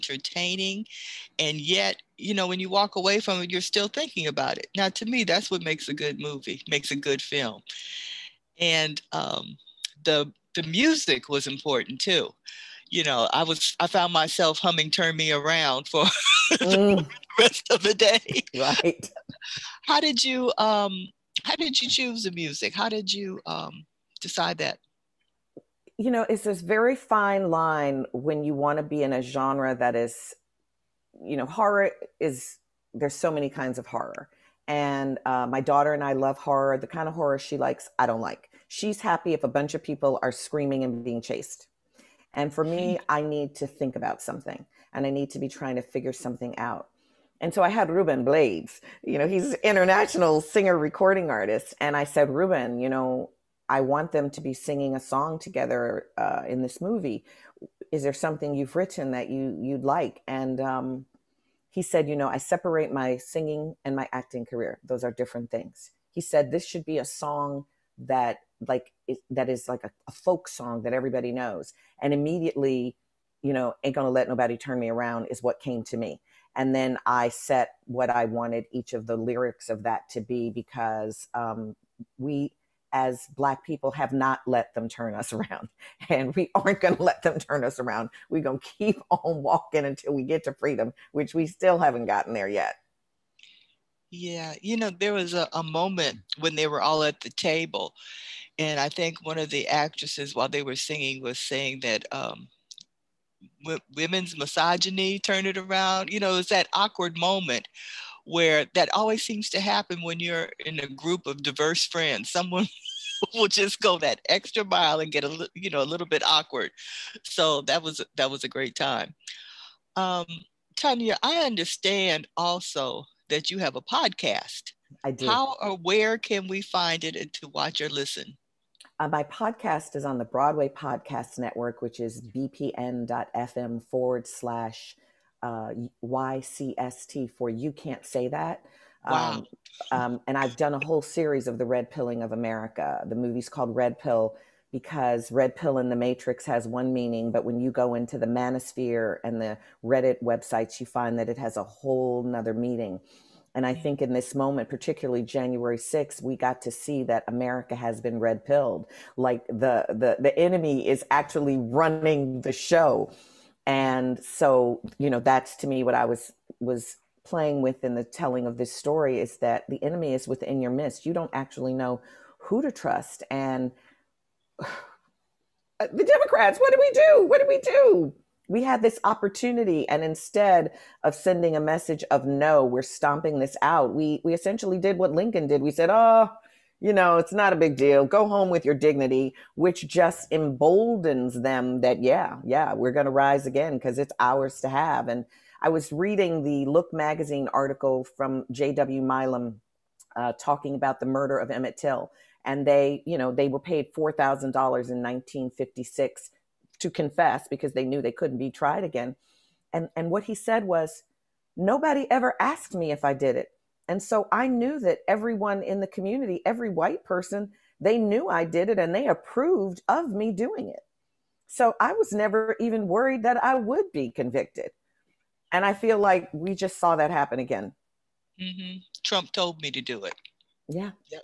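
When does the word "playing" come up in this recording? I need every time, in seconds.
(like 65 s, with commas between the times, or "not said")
167 s.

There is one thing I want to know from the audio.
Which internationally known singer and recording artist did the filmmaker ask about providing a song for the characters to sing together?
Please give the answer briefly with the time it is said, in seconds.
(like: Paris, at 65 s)
Ruben Blades, at 47 s.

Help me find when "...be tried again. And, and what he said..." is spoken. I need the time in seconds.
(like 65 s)
208 s.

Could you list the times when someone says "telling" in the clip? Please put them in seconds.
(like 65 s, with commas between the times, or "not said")
168 s.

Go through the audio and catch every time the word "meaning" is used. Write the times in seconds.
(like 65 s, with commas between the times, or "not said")
146 s, 152 s.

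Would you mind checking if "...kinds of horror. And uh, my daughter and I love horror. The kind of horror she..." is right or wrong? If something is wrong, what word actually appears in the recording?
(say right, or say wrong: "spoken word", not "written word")
right.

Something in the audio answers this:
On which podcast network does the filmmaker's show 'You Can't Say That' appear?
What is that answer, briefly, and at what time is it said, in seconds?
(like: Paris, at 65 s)
Broadway Podcast Network, at 130 s.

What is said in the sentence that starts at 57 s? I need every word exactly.
Is there something you've written that you you'd like?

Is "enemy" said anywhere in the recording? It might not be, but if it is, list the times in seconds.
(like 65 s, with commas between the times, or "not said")
160 s, 169 s.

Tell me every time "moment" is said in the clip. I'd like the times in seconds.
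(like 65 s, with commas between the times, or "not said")
95 s, 107 s, 154 s.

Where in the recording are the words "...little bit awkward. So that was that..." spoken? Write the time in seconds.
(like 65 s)
115 s.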